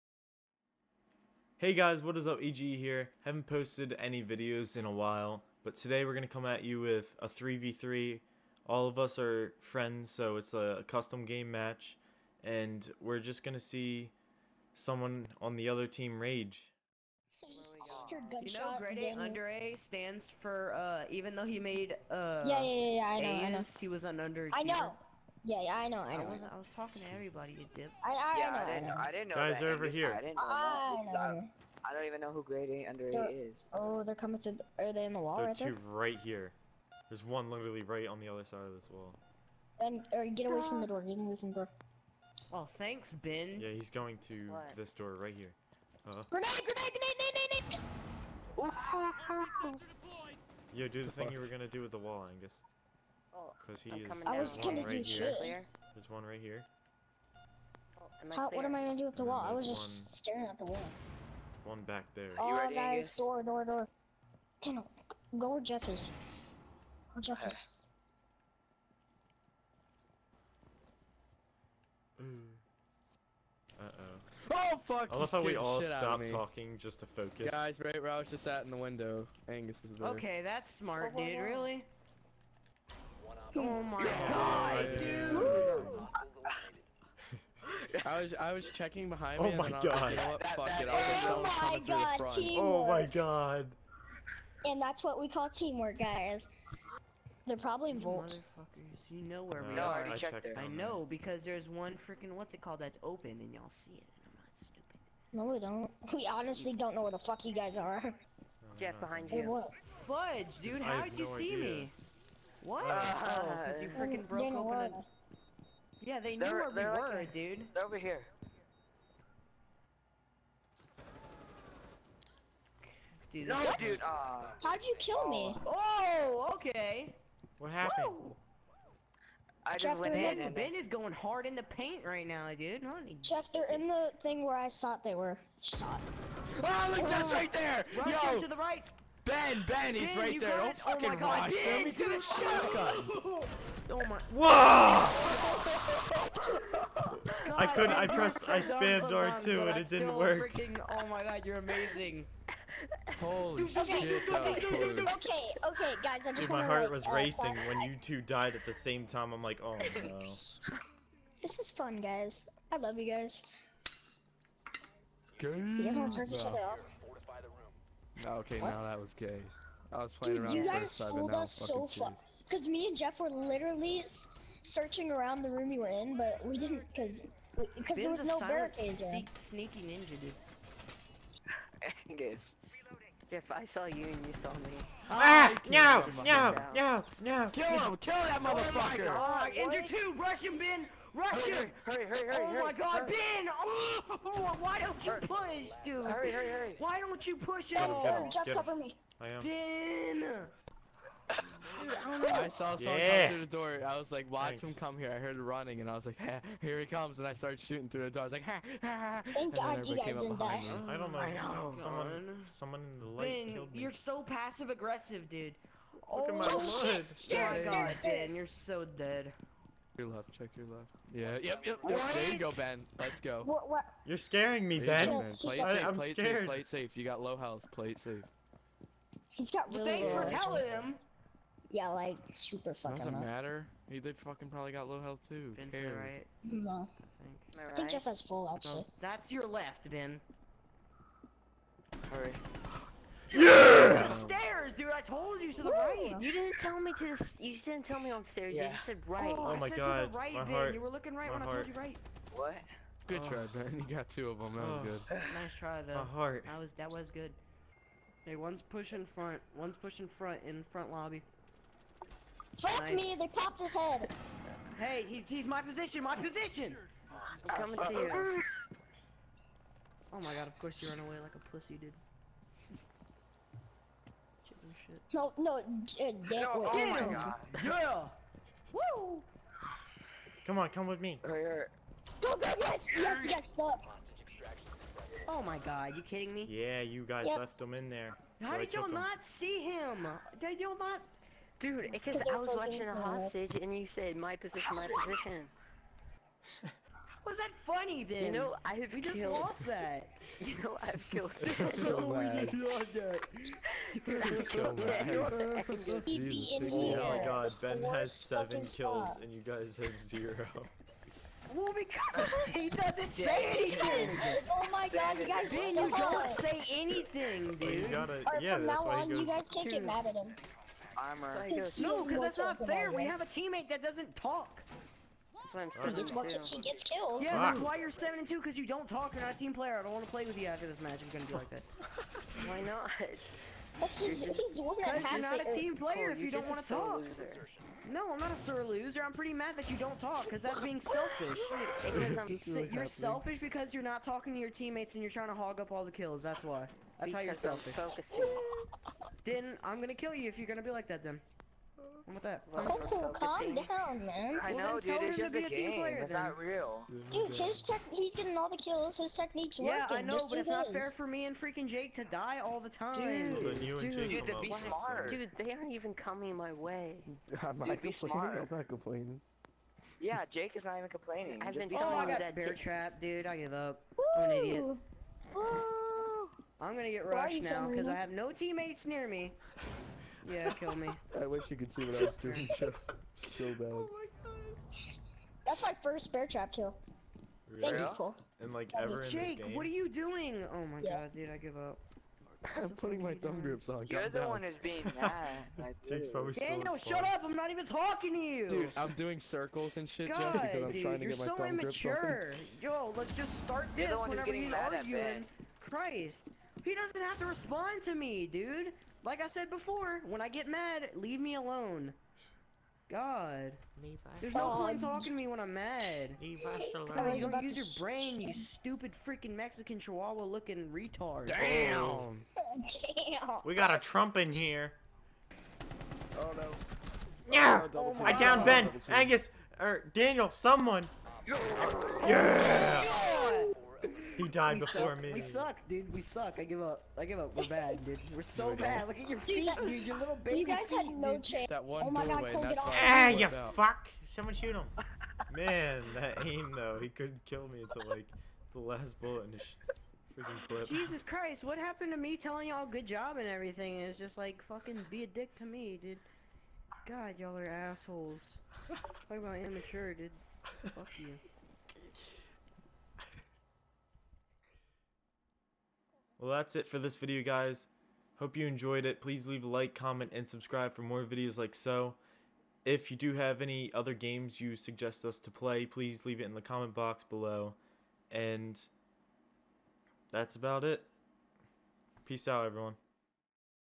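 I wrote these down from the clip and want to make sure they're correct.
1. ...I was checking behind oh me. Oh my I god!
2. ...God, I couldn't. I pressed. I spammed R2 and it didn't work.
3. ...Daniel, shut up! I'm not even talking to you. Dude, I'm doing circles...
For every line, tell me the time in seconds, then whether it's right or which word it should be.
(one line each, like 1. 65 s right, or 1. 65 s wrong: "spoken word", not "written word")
1. 88 s right
2. 146 s right
3. 396 s right.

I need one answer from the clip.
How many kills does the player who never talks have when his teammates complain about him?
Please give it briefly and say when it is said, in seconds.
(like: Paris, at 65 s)
7, at 308 s.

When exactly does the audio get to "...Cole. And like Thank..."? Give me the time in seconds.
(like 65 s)
387 s.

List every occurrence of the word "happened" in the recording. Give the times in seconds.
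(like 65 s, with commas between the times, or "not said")
127 s, 451 s.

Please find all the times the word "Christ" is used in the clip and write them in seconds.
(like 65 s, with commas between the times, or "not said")
405 s, 451 s.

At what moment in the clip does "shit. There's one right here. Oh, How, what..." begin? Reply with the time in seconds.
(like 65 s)
55 s.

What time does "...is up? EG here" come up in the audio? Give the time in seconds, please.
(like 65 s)
2 s.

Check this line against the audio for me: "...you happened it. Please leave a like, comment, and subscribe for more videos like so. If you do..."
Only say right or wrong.
wrong.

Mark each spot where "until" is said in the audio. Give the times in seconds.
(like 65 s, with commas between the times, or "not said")
447 s.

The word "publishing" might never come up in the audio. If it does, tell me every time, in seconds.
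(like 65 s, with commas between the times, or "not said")
not said.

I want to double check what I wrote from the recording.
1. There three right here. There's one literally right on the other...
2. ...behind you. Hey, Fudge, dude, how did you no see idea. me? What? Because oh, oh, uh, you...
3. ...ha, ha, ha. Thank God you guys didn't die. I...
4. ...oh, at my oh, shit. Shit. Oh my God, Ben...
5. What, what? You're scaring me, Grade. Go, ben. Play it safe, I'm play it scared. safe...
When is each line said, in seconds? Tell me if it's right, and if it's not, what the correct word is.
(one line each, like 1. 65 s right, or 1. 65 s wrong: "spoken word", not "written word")
1. 35 s wrong: "two", not "three"
2. 109 s right
3. 208 s right
4. 216 s right
5. 223 s wrong: "Ben", not "Grade".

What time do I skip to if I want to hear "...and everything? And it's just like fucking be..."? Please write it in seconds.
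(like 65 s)
453 s.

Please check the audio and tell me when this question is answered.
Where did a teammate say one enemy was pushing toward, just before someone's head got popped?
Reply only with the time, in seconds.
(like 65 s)
260 s.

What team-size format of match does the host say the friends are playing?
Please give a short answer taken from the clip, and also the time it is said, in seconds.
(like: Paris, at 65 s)
3v3, at 7 s.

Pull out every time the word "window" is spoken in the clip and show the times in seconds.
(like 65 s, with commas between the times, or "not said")
78 s.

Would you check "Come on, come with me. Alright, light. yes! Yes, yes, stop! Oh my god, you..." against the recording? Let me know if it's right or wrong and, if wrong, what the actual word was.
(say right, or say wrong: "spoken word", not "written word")
wrong: "alright", not "light".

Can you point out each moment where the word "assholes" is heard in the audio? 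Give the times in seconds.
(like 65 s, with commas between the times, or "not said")
457 s.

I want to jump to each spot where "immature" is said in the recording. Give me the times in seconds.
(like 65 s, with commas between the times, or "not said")
402 s, 459 s.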